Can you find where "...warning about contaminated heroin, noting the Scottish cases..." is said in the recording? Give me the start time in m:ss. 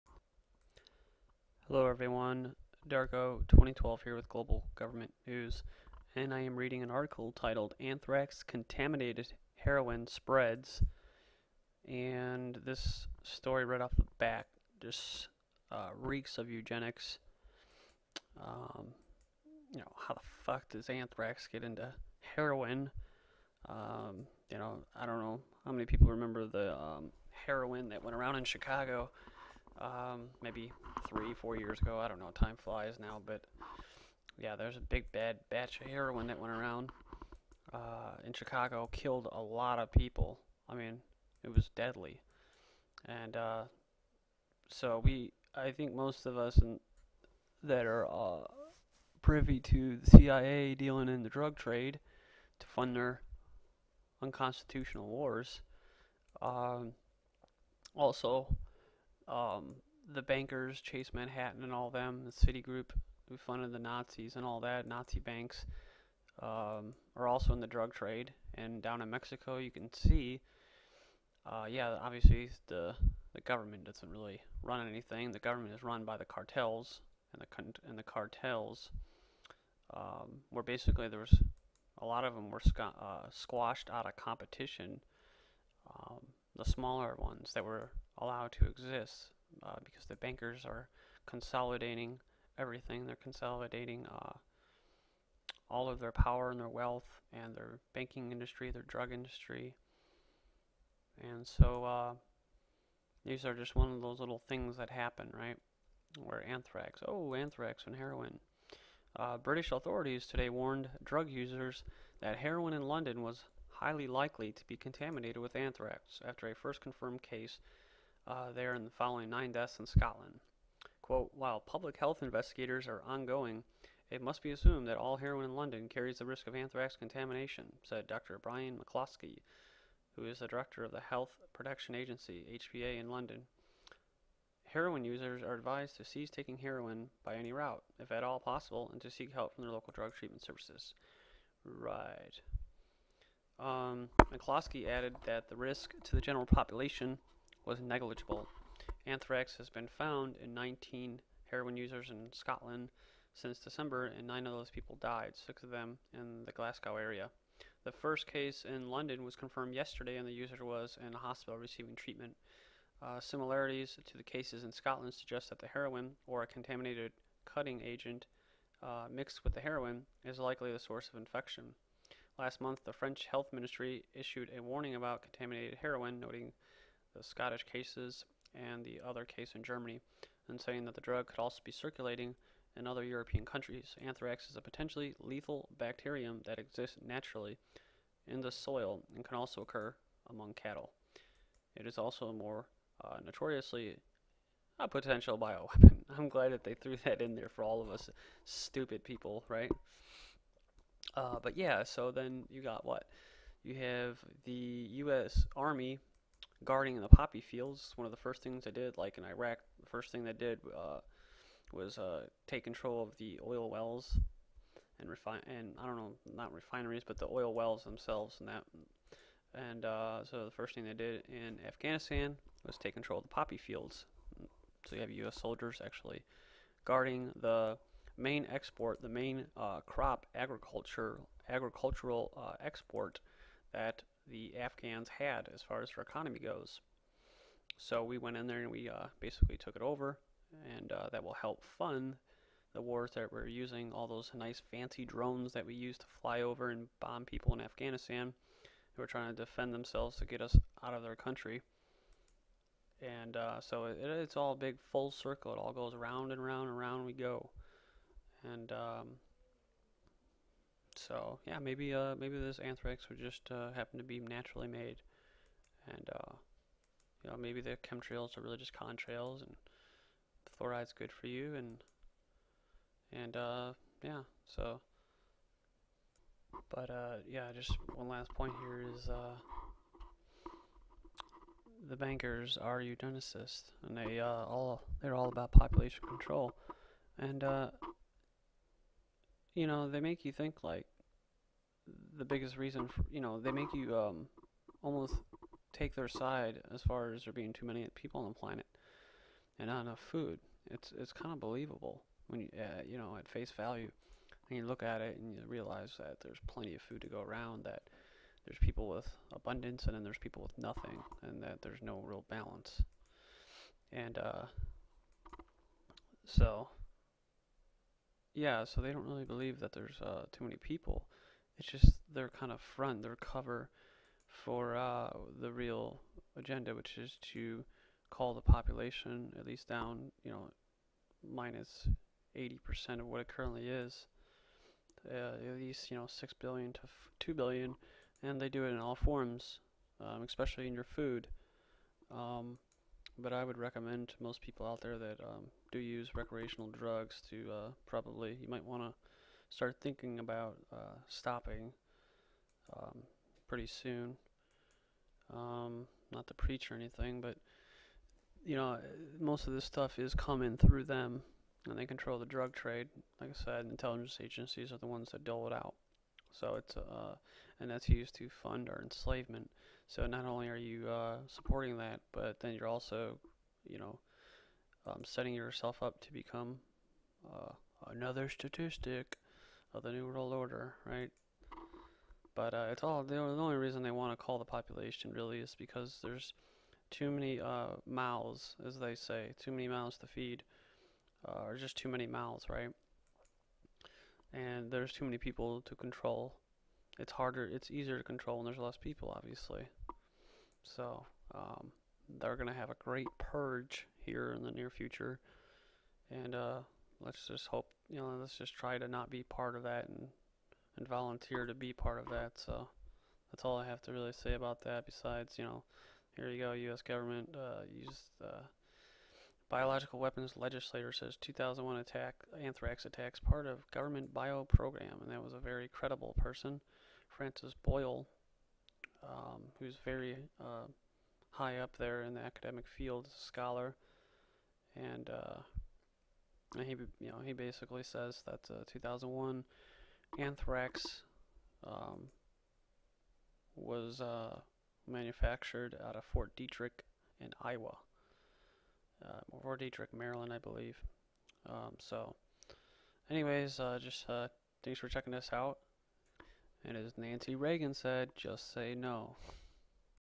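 2:54.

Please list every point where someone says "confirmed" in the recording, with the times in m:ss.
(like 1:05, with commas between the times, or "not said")
1:56, 2:39.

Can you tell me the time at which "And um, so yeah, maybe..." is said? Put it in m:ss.
4:18.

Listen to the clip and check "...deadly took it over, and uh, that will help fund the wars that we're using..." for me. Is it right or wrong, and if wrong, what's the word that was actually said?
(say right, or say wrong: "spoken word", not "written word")
wrong: "basically", not "deadly".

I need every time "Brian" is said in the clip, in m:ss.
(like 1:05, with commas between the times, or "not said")
2:08.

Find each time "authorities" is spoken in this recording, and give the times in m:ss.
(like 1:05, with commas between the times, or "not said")
1:49.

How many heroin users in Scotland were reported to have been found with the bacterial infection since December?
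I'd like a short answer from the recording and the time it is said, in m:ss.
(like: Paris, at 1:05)
19, at 2:30.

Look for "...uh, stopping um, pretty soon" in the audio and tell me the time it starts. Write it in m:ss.
5:50.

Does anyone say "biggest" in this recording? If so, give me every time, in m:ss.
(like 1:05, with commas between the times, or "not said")
4:52.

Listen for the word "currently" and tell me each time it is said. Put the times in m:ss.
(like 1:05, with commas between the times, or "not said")
5:33.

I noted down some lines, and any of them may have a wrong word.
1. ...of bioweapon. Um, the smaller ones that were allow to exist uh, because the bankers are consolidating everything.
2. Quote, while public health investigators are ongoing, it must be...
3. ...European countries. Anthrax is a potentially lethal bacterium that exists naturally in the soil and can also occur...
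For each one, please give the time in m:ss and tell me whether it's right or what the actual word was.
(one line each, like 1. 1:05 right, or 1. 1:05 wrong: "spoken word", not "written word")
1. 1:24 wrong: "competition", not "bioweapon"
2. 2:01 right
3. 3:03 right.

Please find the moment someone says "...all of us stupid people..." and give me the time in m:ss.
3:17.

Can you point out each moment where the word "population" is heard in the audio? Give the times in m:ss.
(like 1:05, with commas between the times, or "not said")
2:26, 4:45, 5:28, 6:24.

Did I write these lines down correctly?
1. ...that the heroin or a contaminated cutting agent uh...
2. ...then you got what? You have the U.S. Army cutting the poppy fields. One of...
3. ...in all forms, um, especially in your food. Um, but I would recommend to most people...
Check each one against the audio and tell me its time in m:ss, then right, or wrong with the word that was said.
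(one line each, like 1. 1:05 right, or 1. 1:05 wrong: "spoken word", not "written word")
1. 2:45 right
2. 3:22 wrong: "guarding", not "cutting"
3. 5:38 right.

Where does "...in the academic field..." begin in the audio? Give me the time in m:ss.
7:12.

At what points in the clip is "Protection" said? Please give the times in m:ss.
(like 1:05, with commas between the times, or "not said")
2:11.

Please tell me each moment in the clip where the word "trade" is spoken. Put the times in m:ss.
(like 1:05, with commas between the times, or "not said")
0:51, 1:07, 6:02.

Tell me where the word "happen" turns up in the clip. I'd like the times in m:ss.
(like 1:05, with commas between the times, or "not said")
1:44, 4:23.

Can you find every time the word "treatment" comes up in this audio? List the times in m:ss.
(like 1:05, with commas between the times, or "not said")
2:20, 2:41.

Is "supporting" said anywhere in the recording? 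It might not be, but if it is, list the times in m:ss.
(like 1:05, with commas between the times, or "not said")
6:11.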